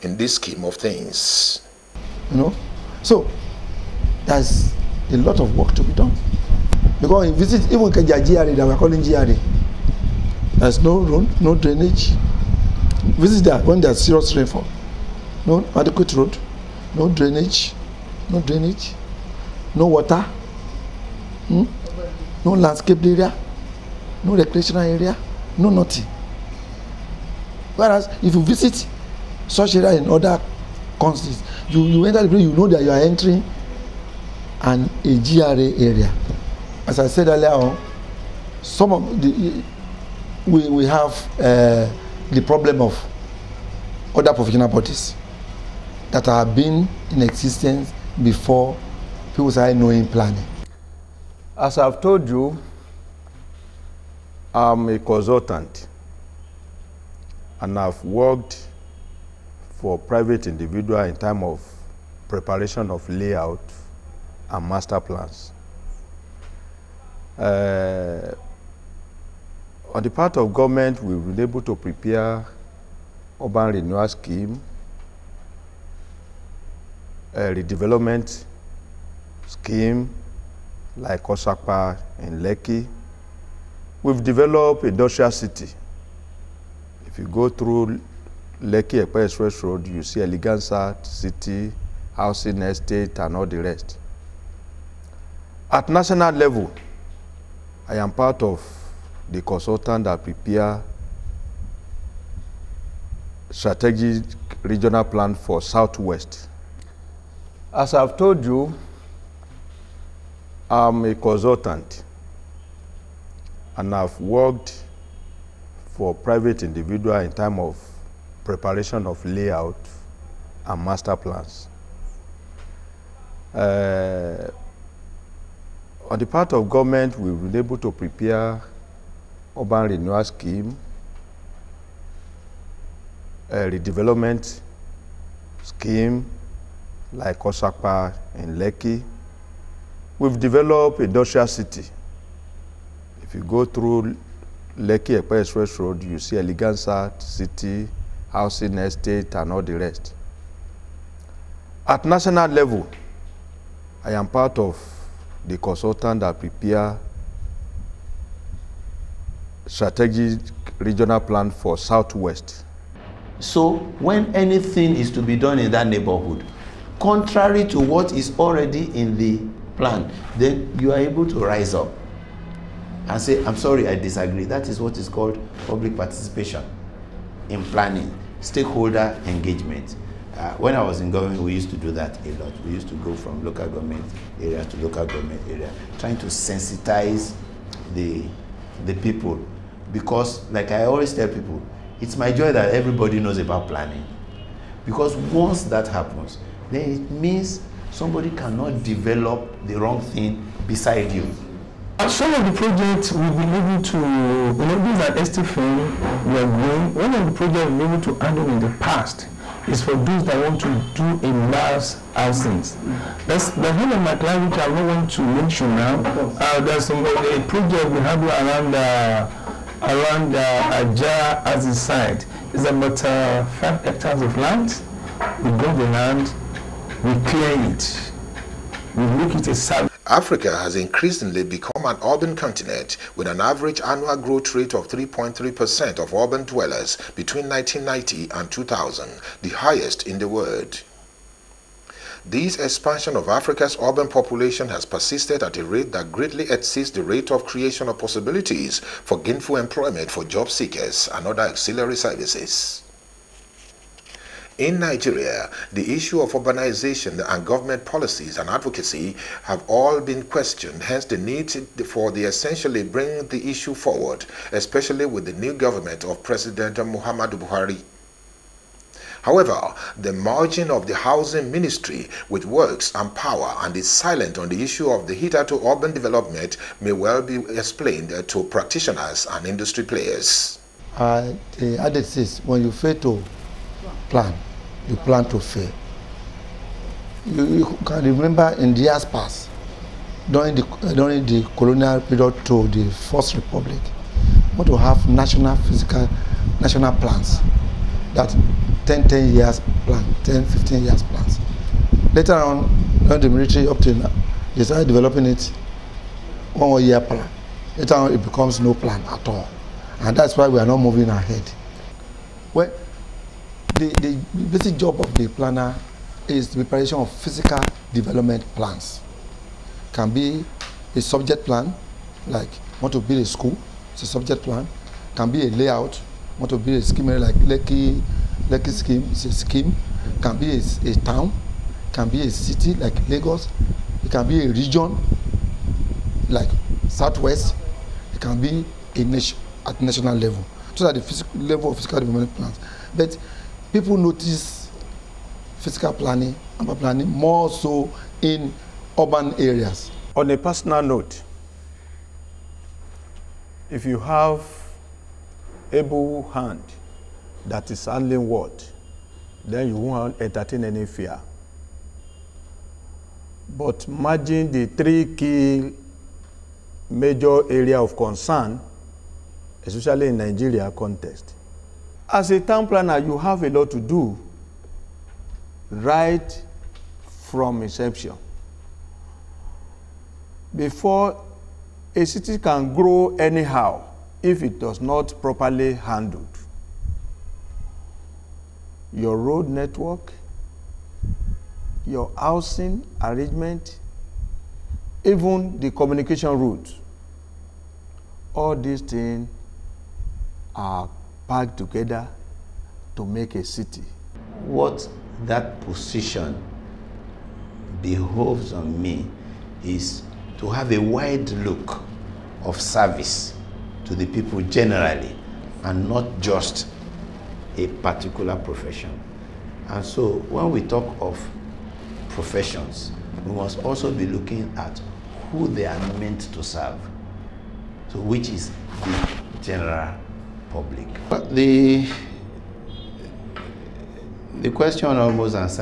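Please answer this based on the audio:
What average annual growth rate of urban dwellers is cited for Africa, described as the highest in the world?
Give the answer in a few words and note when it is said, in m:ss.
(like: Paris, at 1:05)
3.3%, at 3:54.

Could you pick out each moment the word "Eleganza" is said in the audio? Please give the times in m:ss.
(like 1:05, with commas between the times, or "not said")
1:30, 2:26.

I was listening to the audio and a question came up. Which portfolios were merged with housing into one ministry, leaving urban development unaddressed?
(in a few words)
Works and power.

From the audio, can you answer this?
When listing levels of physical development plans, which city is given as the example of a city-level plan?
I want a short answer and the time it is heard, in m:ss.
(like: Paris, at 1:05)
Lagos, at 5:33.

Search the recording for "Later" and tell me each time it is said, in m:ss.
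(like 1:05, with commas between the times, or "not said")
5:02, 5:07.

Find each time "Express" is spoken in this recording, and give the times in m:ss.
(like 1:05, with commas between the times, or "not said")
1:29, 2:25.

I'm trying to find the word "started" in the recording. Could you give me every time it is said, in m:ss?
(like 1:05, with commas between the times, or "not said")
0:49, 5:04.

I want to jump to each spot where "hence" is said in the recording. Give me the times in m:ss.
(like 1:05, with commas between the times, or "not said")
4:20.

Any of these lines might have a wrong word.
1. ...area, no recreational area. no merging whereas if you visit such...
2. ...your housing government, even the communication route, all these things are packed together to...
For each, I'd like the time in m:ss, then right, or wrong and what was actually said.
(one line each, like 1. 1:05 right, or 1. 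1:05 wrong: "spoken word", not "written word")
1. 0:23 wrong: "nothing", not "merging"
2. 6:31 wrong: "arrangement", not "government".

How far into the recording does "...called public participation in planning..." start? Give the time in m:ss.
2:55.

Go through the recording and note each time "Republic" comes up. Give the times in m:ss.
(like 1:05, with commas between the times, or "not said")
4:53.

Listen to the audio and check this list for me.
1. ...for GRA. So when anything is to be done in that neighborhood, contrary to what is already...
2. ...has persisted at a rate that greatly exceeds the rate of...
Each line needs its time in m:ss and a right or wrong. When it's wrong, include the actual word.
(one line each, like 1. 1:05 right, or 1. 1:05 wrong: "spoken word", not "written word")
1. 2:41 wrong: "Southwest", not "GRA"
2. 4:04 right.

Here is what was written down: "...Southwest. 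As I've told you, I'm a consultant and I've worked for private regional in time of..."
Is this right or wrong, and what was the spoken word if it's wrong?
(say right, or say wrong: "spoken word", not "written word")
wrong: "individual", not "regional".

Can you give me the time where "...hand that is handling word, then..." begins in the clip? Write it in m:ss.
5:56.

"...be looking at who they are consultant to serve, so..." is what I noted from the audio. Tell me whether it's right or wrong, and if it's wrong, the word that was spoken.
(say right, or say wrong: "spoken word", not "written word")
wrong: "meant", not "consultant".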